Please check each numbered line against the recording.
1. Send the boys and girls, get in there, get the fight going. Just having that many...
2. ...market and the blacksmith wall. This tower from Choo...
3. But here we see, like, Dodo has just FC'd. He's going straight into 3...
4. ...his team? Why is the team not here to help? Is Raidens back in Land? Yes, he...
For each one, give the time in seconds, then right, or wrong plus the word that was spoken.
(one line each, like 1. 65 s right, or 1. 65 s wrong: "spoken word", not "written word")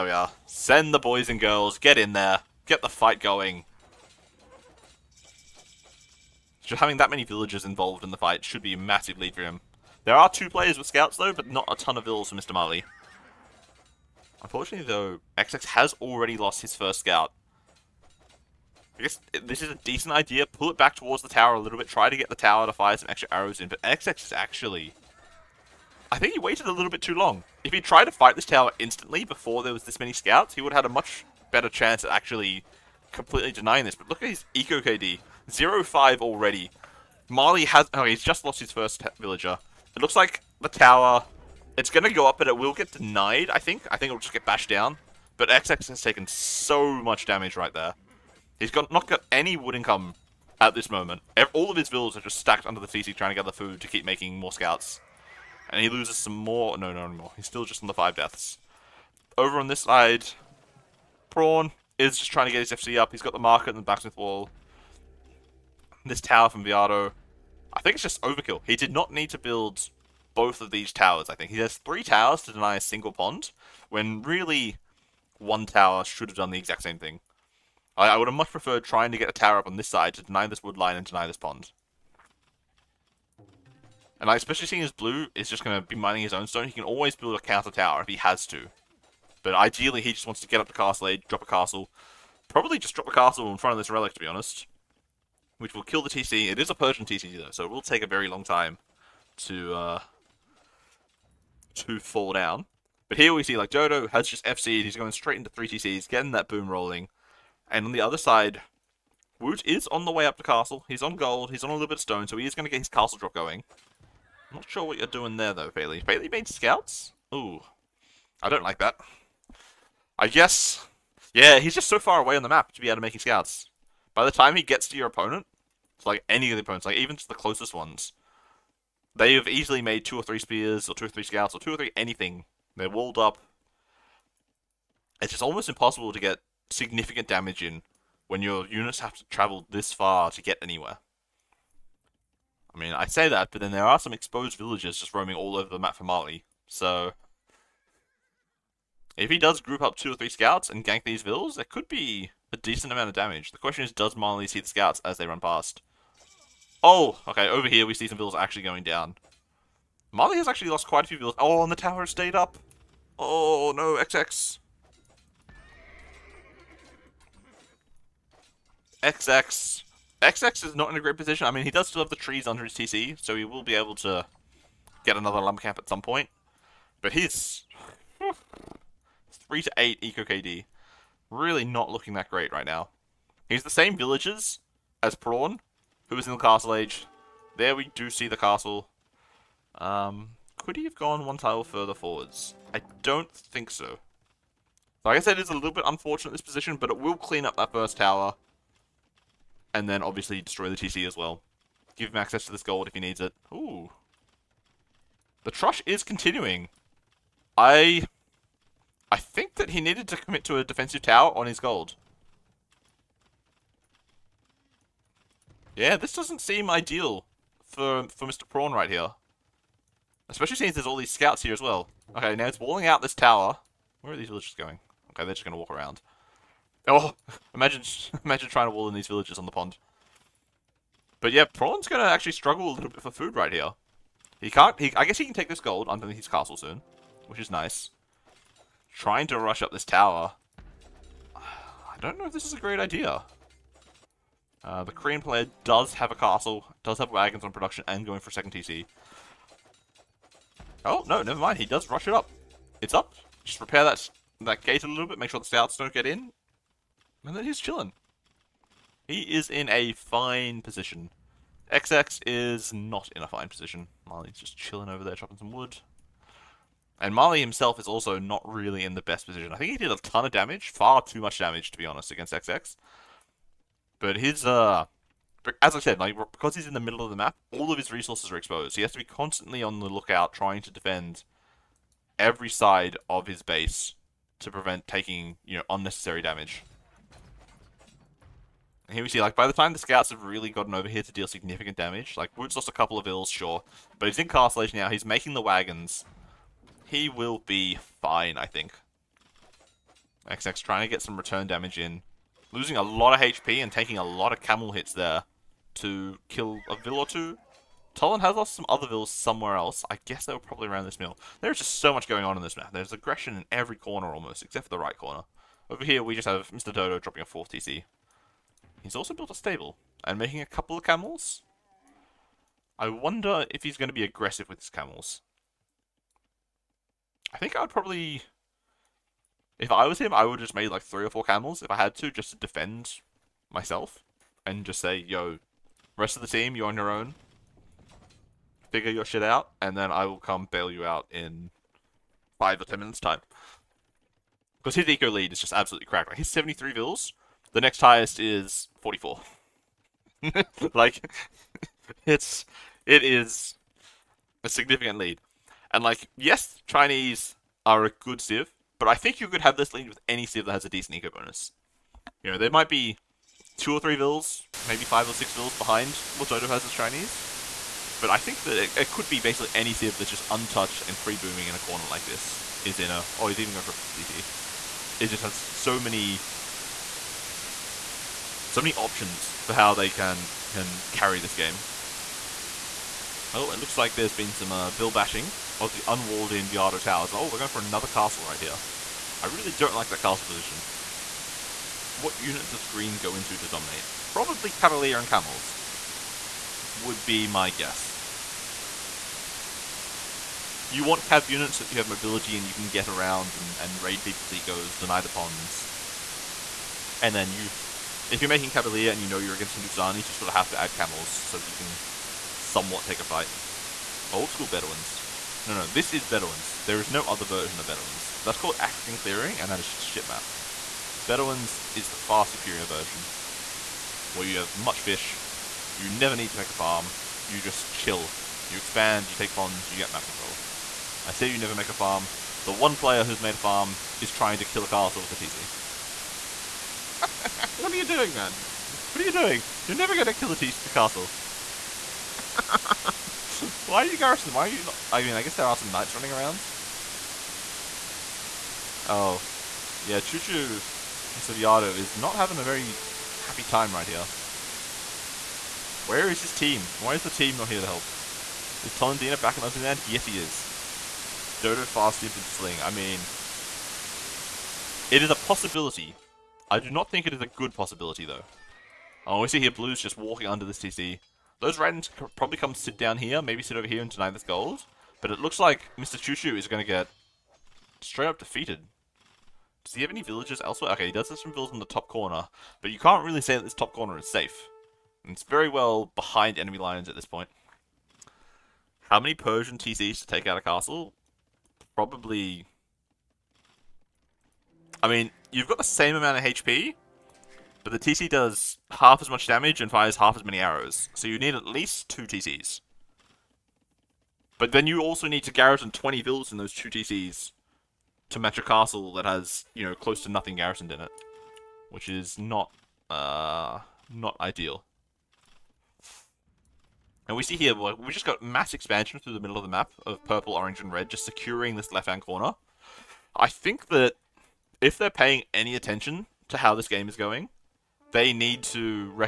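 1. 0 s right
2. 63 s wrong: "Viado", not "Choo"
3. 103 s right
4. 456 s wrong: "Tulendeena", not "Raidens".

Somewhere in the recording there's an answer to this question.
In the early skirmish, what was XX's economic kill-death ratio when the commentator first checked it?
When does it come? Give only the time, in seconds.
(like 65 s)
35 s.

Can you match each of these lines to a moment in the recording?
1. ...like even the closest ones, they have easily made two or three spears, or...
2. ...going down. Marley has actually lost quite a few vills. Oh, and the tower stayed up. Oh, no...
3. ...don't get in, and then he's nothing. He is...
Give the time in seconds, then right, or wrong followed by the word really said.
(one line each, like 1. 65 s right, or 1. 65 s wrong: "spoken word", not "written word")
1. 126 s right
2. 158 s right
3. 255 s wrong: "chilling", not "nothing".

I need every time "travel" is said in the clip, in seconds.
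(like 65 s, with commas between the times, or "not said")
139 s.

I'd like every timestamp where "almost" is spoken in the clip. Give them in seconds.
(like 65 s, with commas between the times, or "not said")
135 s, 314 s.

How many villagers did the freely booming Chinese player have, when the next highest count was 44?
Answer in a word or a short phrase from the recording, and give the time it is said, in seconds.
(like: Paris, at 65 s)
73, at 346 s.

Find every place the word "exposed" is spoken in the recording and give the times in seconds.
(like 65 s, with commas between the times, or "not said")
144 s, 278 s.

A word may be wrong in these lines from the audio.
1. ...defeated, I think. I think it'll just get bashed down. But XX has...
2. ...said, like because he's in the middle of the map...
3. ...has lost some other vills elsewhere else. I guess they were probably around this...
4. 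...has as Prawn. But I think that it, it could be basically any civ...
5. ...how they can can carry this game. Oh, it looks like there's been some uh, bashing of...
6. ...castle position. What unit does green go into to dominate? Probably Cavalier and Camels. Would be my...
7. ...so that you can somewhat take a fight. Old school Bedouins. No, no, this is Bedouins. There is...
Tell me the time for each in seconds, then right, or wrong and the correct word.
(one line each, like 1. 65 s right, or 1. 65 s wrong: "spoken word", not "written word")
1. 42 s wrong: "denied", not "defeated"
2. 275 s right
3. 308 s wrong: "somewhere", not "elsewhere"
4. 366 s wrong: "Chinese", not "Prawn"
5. 379 s right
6. 389 s right
7. 411 s right.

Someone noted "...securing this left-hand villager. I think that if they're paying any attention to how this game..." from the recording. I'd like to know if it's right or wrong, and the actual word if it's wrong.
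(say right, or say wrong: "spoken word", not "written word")
wrong: "corner", not "villager".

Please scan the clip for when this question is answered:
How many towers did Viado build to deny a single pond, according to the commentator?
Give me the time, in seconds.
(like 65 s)
71 s.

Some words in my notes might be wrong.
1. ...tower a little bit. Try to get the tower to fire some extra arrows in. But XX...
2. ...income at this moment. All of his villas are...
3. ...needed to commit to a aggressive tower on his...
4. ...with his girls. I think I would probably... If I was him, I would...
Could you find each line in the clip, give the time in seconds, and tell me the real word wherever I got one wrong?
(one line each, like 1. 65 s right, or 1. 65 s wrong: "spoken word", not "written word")
1. 21 s right
2. 49 s right
3. 209 s wrong: "defensive", not "aggressive"
4. 324 s wrong: "camels", not "girls".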